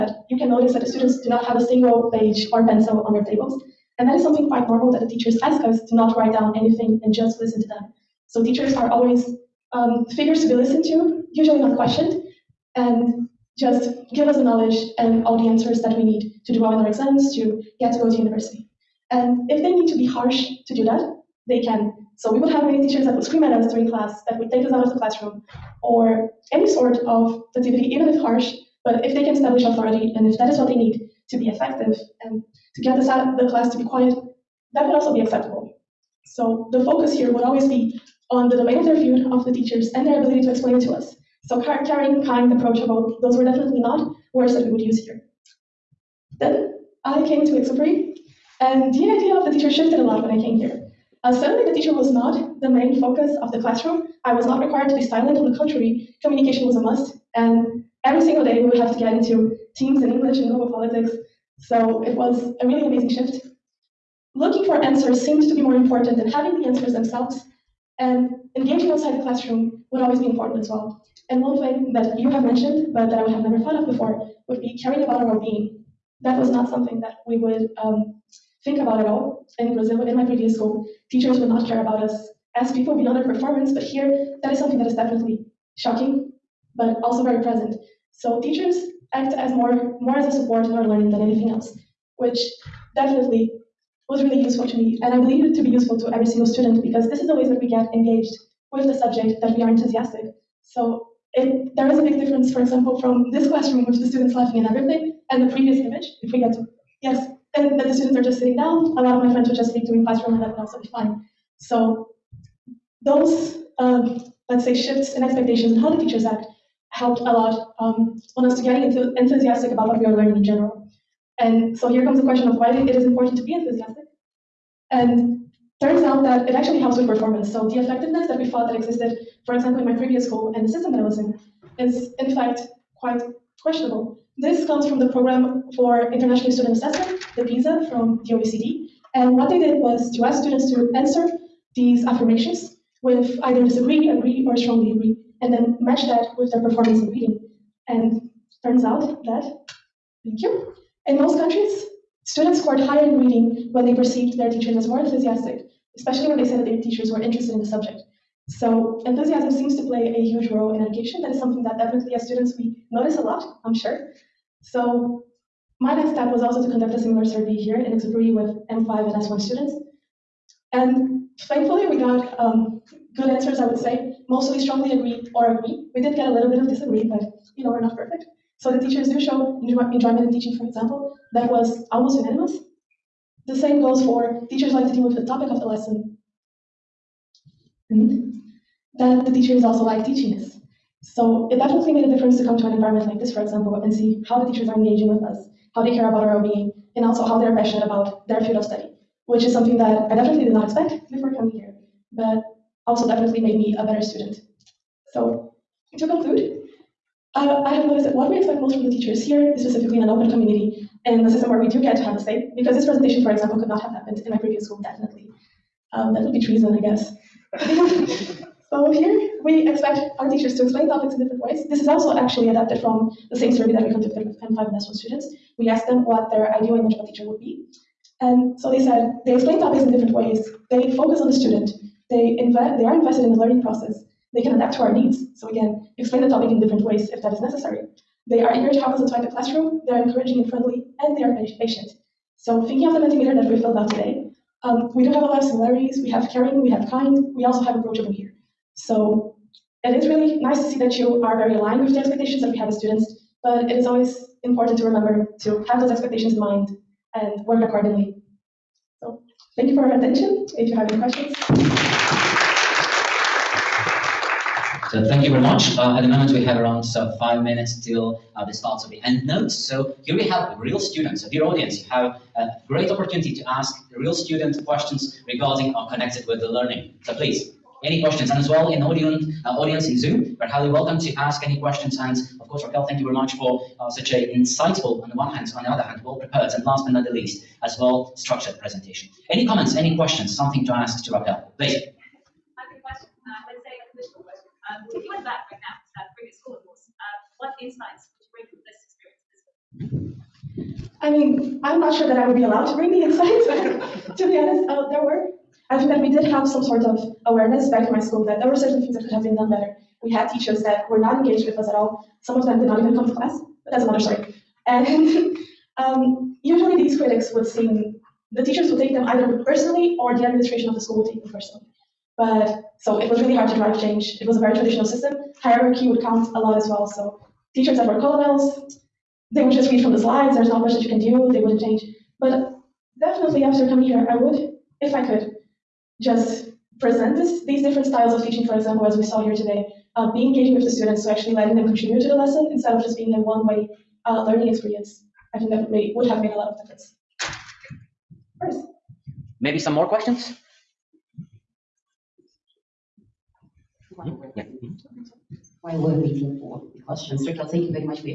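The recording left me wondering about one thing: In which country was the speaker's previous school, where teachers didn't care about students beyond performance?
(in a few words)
Brazil.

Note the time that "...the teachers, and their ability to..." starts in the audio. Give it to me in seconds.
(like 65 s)
39 s.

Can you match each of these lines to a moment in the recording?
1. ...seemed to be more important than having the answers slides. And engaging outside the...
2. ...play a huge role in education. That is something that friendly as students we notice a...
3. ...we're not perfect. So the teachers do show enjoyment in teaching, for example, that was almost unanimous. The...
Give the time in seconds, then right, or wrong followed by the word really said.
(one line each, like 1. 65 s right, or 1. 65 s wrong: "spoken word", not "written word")
1. 65 s wrong: "themselves", not "slides"
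2. 159 s wrong: "definitely", not "friendly"
3. 177 s right.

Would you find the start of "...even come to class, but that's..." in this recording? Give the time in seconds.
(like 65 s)
312 s.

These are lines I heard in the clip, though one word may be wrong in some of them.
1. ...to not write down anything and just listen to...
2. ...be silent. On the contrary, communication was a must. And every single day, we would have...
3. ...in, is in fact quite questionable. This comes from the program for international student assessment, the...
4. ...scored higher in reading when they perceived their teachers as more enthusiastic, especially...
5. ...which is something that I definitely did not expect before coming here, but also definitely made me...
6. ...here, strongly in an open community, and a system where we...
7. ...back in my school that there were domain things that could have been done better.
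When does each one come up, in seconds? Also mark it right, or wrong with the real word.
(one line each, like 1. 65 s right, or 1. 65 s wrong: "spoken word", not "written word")
1. 5 s right
2. 54 s right
3. 131 s right
4. 152 s right
5. 199 s right
6. 209 s wrong: "specifically", not "strongly"
7. 307 s wrong: "certain", not "domain".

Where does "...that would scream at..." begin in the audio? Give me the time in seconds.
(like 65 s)
23 s.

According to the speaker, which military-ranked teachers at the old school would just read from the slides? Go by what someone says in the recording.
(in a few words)
Colonels.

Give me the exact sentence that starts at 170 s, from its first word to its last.
And thankfully we got um, good answers, I would say.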